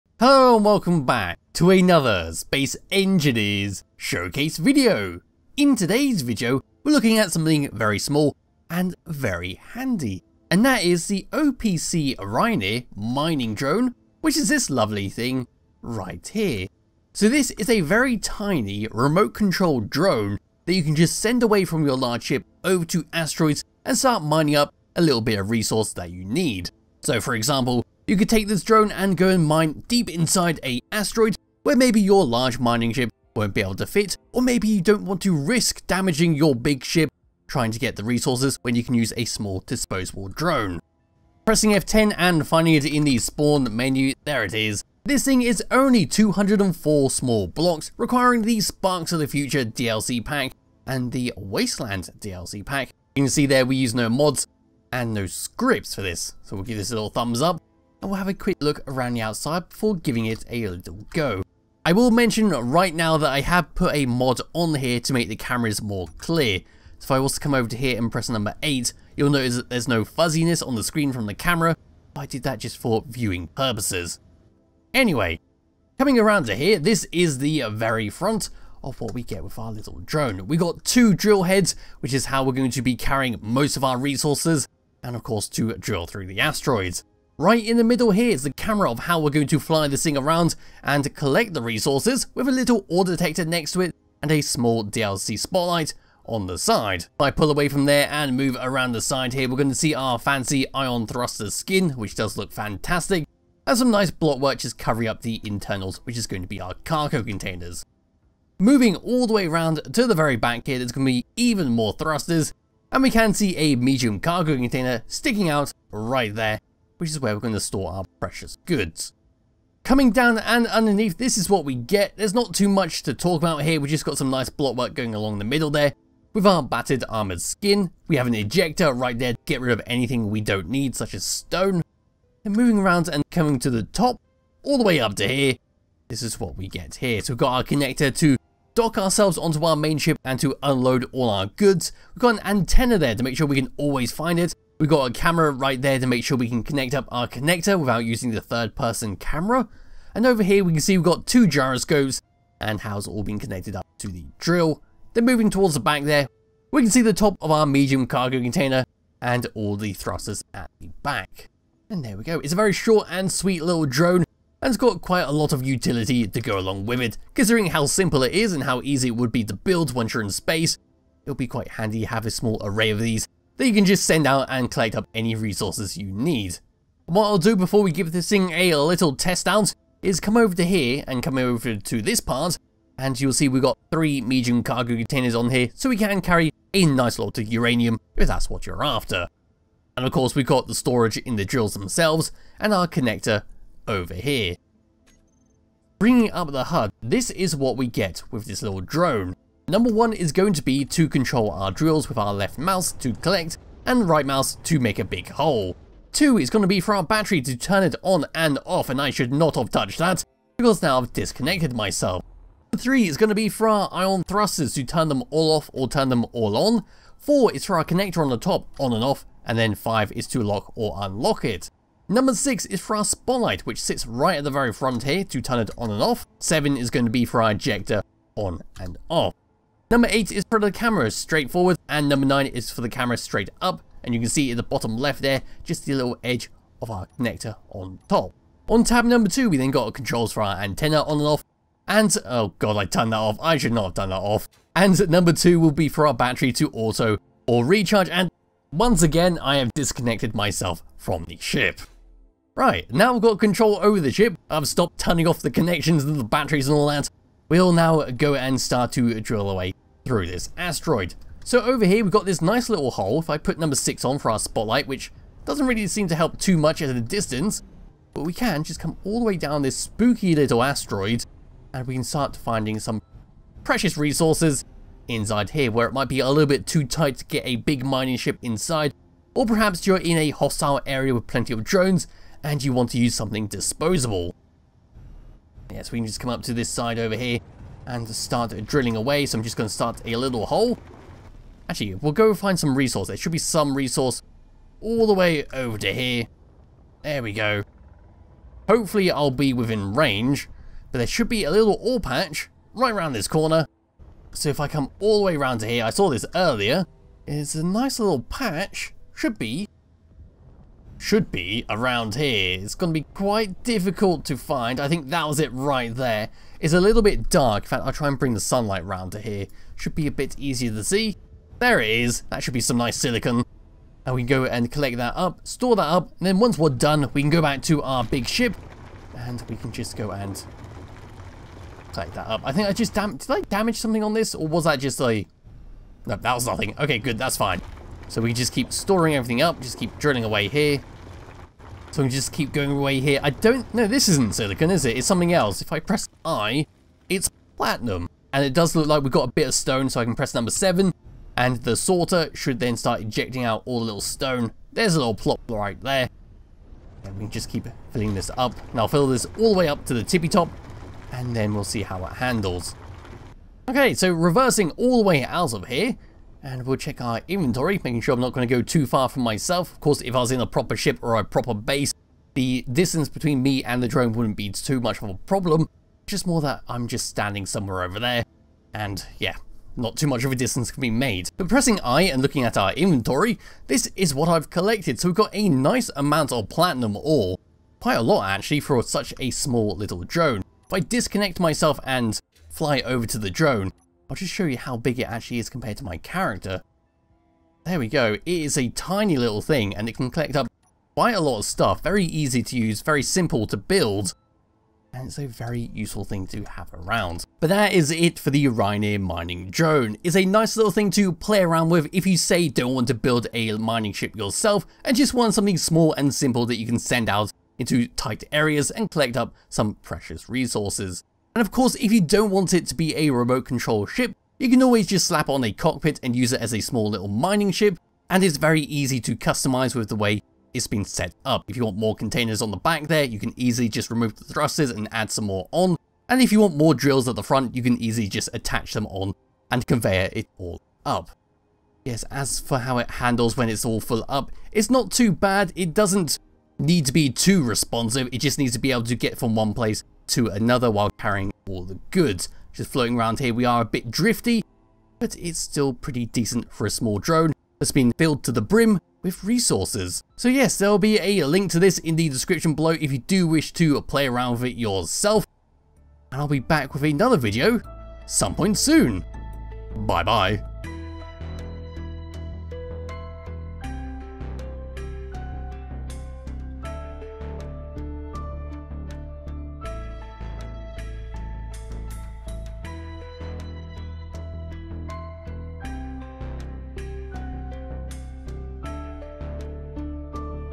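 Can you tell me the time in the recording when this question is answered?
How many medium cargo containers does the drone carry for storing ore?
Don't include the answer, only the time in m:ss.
3:03.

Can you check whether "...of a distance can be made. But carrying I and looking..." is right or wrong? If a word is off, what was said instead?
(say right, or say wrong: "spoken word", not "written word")
wrong: "pressing", not "carrying".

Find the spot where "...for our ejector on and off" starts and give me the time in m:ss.
3:47.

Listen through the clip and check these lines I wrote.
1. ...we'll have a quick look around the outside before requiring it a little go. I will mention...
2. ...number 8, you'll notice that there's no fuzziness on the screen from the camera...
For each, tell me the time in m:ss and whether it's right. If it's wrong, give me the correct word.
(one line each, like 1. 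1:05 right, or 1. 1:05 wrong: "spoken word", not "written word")
1. 0:58 wrong: "giving", not "requiring"
2. 1:08 right.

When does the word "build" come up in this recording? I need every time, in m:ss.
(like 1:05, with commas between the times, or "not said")
2:49, 6:43, 6:52.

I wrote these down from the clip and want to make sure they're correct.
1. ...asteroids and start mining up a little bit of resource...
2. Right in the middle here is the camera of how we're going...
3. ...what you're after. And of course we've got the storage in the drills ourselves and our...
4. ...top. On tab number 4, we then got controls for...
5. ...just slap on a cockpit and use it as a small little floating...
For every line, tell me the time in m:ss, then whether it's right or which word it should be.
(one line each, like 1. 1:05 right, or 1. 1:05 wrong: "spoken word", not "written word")
1. 0:23 right
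2. 1:27 right
3. 3:08 wrong: "themselves", not "ourselves"
4. 3:58 wrong: "2", not "4"
5. 7:04 wrong: "mining", not "floating".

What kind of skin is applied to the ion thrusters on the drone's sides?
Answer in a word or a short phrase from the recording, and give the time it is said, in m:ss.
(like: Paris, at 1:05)
Fancy ion thruster skin, at 1:40.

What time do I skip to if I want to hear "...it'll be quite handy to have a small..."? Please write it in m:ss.
2:51.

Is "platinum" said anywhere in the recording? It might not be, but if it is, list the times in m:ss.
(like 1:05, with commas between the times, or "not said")
5:47, 6:26.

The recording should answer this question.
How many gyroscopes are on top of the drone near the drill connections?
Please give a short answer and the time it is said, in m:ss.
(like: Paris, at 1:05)
2, at 2:31.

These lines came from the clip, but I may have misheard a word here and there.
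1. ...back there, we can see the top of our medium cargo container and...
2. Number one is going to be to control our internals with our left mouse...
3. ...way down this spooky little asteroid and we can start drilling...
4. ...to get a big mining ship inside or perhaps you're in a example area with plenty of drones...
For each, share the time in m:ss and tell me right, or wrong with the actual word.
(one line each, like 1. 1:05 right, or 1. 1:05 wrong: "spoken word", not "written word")
1. 2:35 right
2. 3:19 wrong: "drills", not "internals"
3. 4:29 wrong: "finding", not "drilling"
4. 4:37 wrong: "hostile", not "example".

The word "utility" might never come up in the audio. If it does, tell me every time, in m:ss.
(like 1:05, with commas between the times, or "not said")
2:45.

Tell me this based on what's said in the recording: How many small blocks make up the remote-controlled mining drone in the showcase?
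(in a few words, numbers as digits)
204.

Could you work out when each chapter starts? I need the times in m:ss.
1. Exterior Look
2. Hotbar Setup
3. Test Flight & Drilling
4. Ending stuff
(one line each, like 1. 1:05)
1. 1:00
2. 3:15
3. 4:15
4. 6:47.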